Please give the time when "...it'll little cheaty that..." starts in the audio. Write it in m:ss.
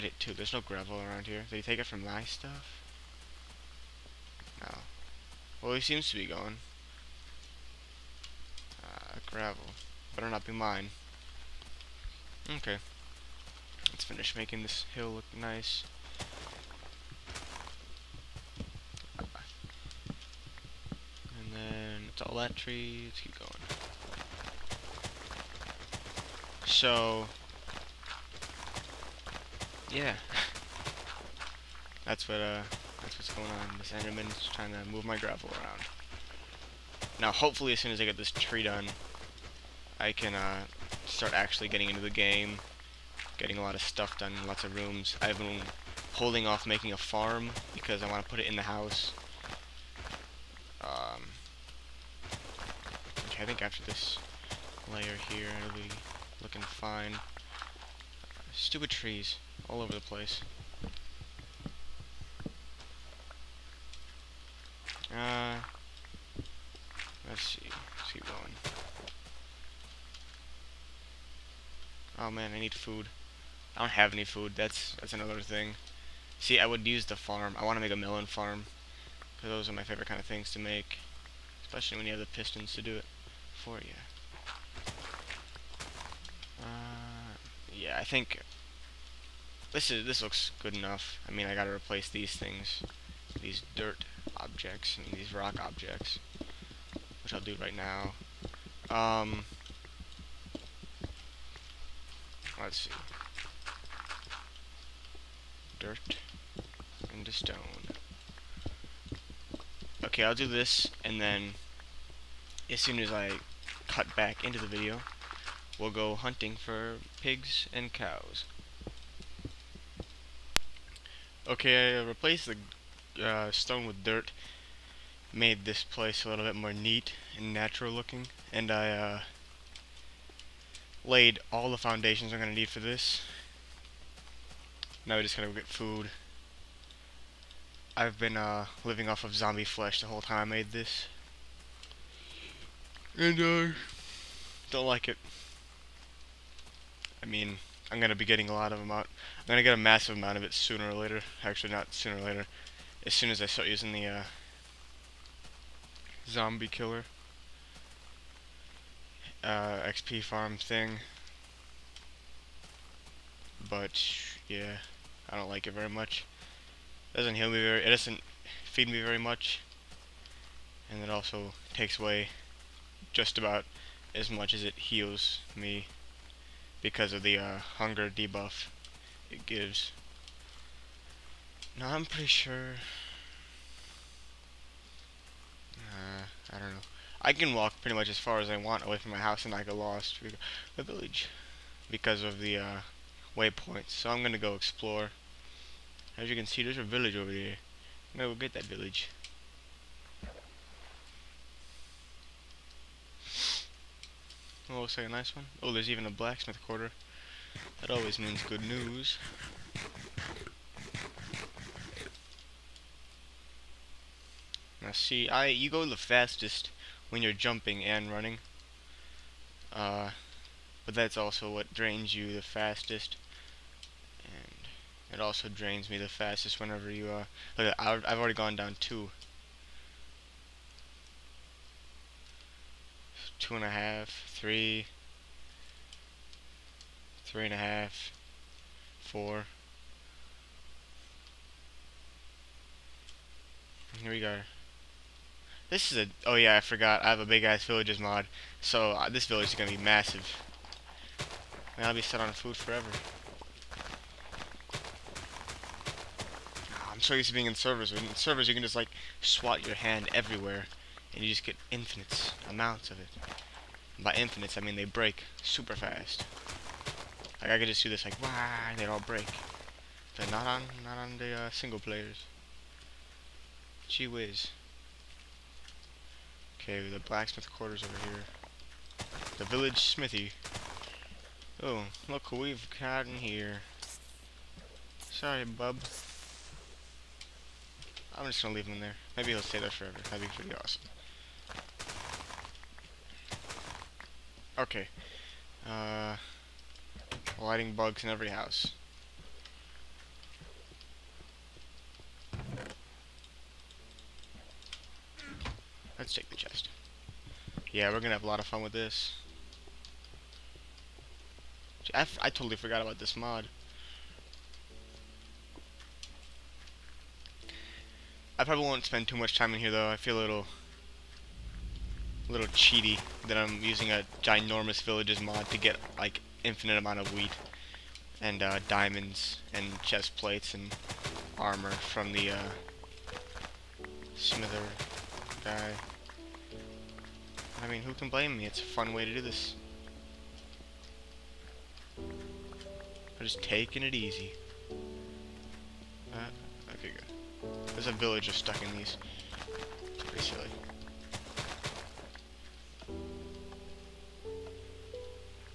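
5:20.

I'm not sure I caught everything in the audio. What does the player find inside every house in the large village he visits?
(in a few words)
lighting bugs.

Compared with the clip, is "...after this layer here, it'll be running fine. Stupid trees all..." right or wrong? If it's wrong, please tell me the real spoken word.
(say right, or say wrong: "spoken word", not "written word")
wrong: "looking", not "running".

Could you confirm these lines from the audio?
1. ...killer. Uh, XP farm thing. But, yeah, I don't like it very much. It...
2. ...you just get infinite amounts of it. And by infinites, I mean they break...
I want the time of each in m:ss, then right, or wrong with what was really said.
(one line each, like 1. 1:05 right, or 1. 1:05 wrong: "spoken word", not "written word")
1. 2:36 right
2. 4:21 right.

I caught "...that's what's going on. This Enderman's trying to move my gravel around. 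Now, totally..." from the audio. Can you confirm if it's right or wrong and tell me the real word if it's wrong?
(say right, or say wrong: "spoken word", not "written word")
wrong: "hopefully", not "totally".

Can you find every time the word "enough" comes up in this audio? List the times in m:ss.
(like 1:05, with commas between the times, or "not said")
1:30.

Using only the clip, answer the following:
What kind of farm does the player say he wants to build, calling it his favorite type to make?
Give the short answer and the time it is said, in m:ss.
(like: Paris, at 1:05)
melon farm, at 1:17.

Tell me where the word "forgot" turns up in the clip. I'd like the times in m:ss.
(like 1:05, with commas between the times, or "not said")
4:06, 5:12.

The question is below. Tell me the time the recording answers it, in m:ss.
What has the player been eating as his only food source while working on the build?
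2:19.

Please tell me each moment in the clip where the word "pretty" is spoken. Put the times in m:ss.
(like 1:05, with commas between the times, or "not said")
3:02, 3:07, 4:50, 5:50.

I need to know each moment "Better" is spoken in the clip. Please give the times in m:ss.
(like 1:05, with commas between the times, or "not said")
0:10.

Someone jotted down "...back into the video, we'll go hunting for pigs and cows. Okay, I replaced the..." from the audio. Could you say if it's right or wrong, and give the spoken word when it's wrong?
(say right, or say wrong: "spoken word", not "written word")
right.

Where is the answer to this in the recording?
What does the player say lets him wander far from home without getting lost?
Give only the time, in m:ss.
3:13.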